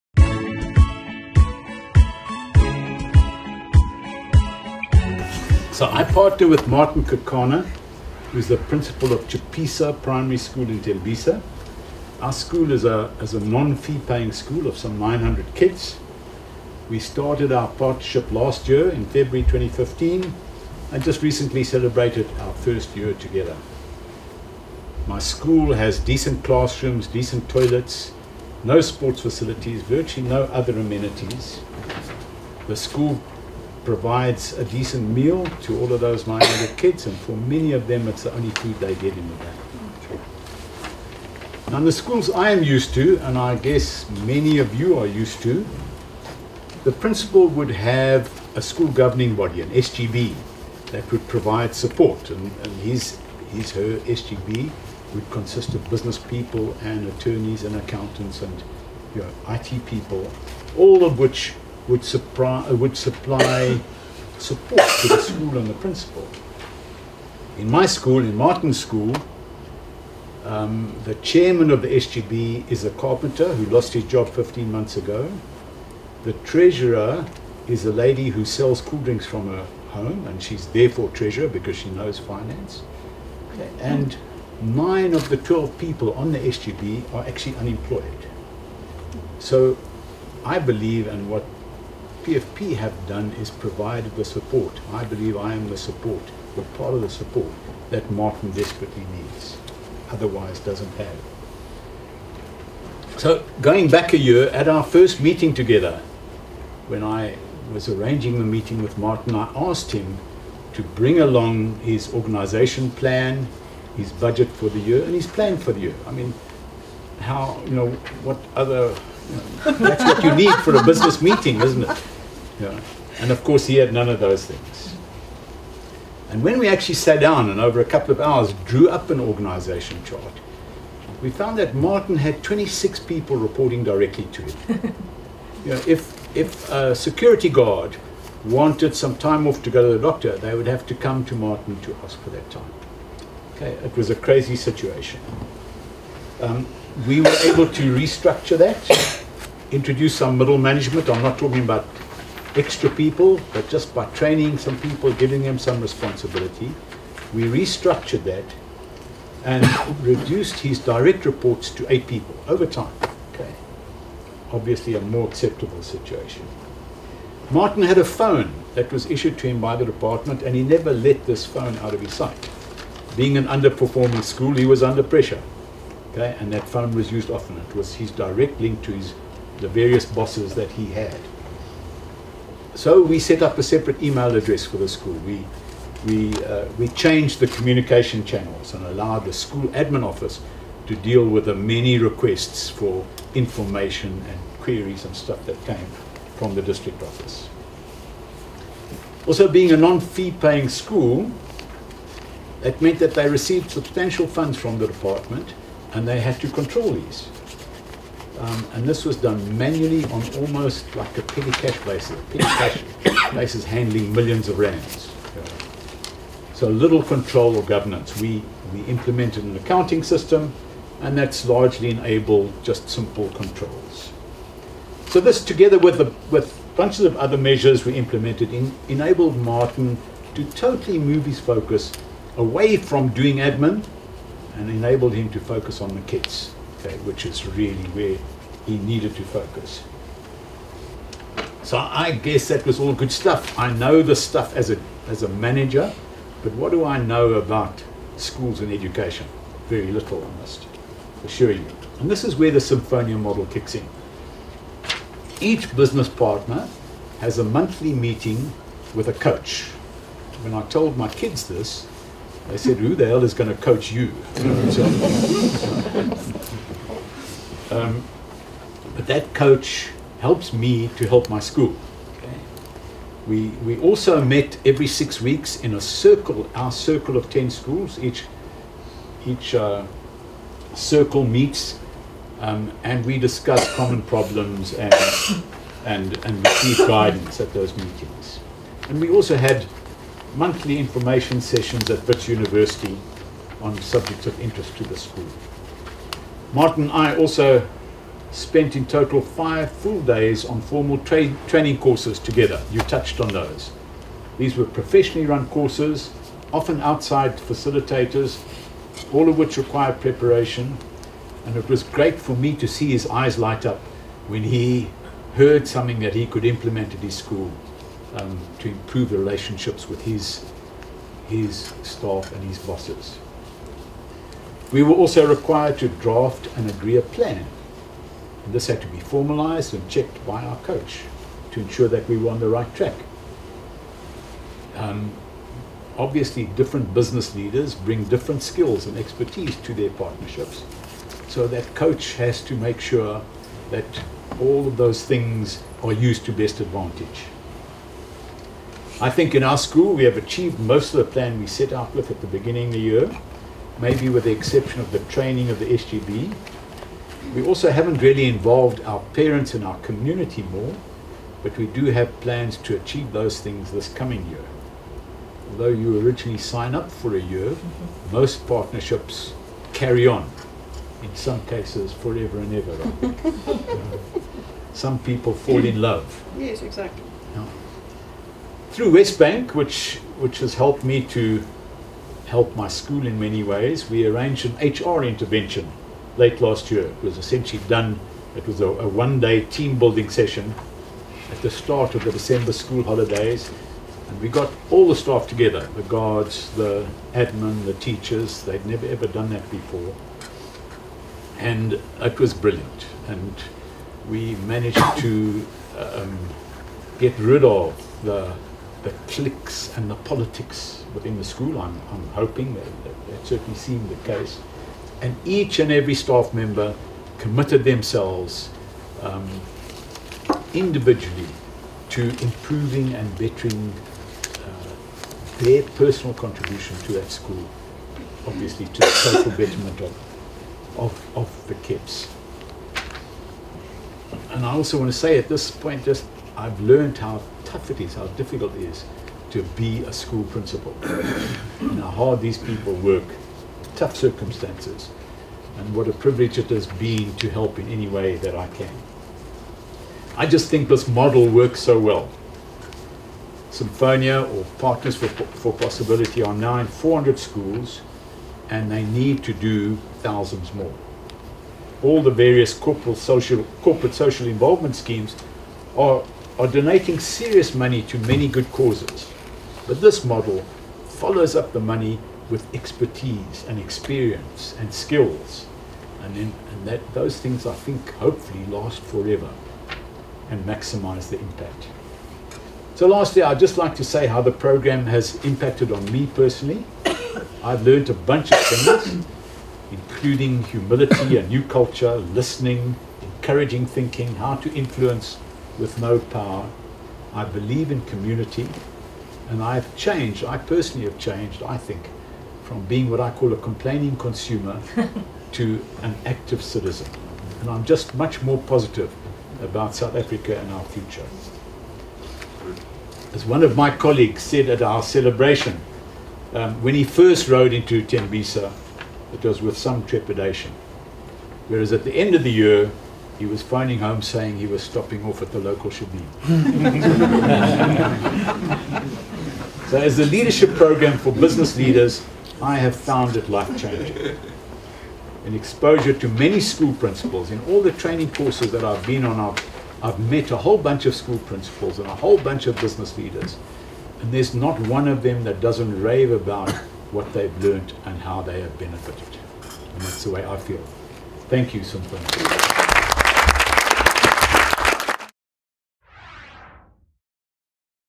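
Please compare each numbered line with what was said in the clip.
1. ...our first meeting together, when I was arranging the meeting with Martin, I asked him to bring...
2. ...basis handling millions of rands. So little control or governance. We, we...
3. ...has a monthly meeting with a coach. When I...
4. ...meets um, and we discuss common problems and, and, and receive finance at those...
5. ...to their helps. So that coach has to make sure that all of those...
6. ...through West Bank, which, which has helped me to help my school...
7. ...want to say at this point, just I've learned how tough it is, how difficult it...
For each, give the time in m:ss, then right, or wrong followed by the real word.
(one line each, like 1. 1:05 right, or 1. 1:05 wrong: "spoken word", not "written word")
1. 1:44 right
2. 3:33 right
3. 4:17 right
4. 4:41 wrong: "guidance", not "finance"
5. 5:39 wrong: "partnerships", not "helps"
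6. 6:18 right
7. 7:14 right.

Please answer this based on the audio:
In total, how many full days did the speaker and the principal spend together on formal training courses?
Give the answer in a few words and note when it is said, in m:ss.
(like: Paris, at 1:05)
5, at 4:59.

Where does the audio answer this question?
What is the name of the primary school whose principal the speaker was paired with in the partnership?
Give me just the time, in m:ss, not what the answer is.
0:09.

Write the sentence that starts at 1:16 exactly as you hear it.
The treasurer is a lady who sells cool drinks from her home, and she's therefore treasurer because she knows finance.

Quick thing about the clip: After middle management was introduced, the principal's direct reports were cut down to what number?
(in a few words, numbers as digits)
8.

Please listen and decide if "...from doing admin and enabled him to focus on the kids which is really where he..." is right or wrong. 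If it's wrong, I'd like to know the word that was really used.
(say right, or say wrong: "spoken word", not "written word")
right.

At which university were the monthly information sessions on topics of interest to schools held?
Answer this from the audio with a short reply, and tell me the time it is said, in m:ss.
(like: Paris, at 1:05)
Wits University, at 4:52.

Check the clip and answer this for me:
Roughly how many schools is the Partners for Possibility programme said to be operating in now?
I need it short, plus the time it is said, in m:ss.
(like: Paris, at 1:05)
400, at 7:36.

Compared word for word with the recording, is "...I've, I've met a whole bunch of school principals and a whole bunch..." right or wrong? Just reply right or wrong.
right.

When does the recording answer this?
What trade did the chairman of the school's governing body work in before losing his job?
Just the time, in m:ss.
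1:12.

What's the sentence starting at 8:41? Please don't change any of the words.
Whereas at the end of the year, he was finding home saying he was stopping off at the local shebeen.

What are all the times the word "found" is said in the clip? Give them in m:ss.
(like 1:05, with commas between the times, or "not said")
2:11, 8:52.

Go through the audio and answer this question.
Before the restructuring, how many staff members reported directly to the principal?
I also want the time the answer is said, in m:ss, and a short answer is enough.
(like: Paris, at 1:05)
26, at 2:12.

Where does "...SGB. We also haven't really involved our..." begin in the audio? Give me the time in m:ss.
5:55.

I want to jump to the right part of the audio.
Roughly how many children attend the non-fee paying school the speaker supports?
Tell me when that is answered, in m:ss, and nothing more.
0:14.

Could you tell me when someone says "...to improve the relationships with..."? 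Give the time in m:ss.
5:18.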